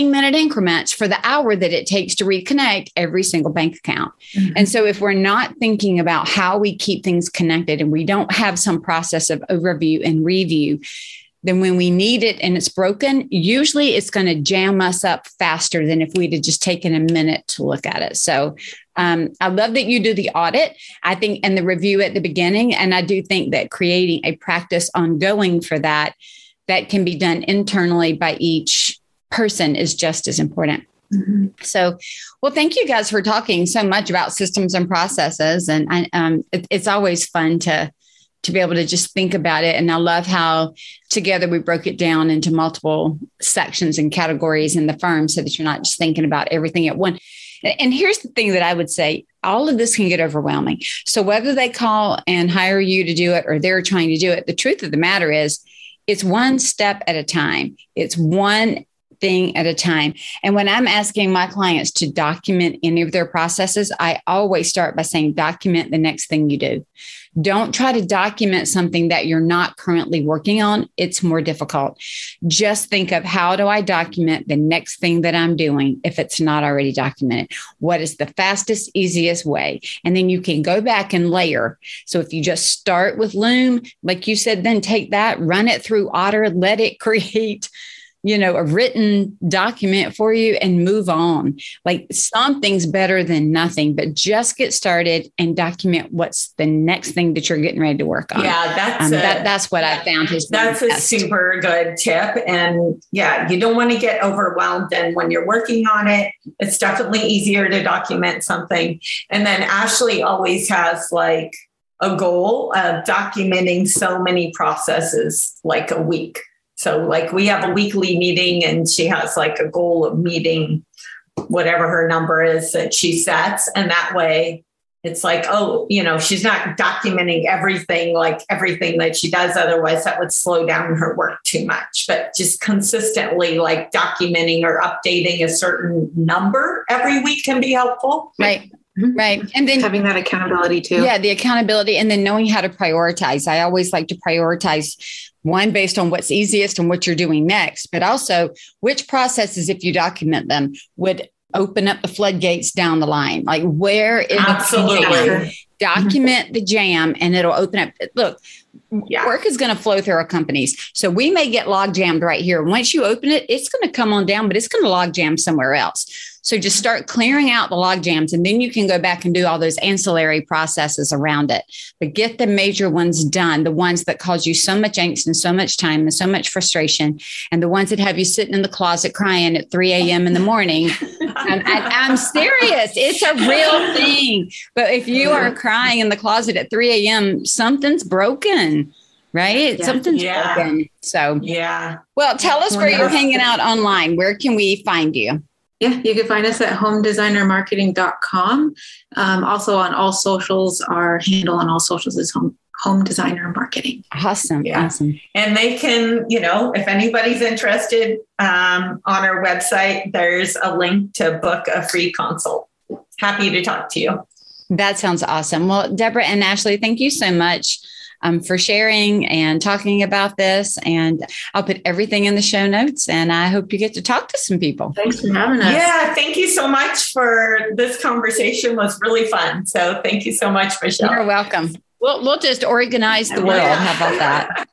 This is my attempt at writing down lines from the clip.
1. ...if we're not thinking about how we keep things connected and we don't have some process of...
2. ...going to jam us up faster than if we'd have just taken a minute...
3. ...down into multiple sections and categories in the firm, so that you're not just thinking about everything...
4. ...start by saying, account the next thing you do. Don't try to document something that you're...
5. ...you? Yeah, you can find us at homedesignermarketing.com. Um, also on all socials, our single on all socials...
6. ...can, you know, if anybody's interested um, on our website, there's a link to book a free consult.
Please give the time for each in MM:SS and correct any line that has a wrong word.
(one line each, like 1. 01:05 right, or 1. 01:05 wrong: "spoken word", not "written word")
1. 00:04 right
2. 00:14 right
3. 00:41 right
4. 01:04 wrong: "document", not "account"
5. 03:15 wrong: "handle", not "single"
6. 03:25 right.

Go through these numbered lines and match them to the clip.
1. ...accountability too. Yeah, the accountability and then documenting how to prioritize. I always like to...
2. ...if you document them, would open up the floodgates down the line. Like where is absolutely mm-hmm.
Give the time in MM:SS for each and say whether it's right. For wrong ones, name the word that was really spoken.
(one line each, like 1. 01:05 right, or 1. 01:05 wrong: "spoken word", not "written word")
1. 02:20 wrong: "knowing", not "documenting"
2. 02:29 right.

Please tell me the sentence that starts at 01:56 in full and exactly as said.
So, like, we have a weekly meeting, and she has like a goal of meeting whatever her number is that she sets.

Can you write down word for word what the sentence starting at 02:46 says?
start clearing out the log jams and then you can go back and do all those ancillary processes around it.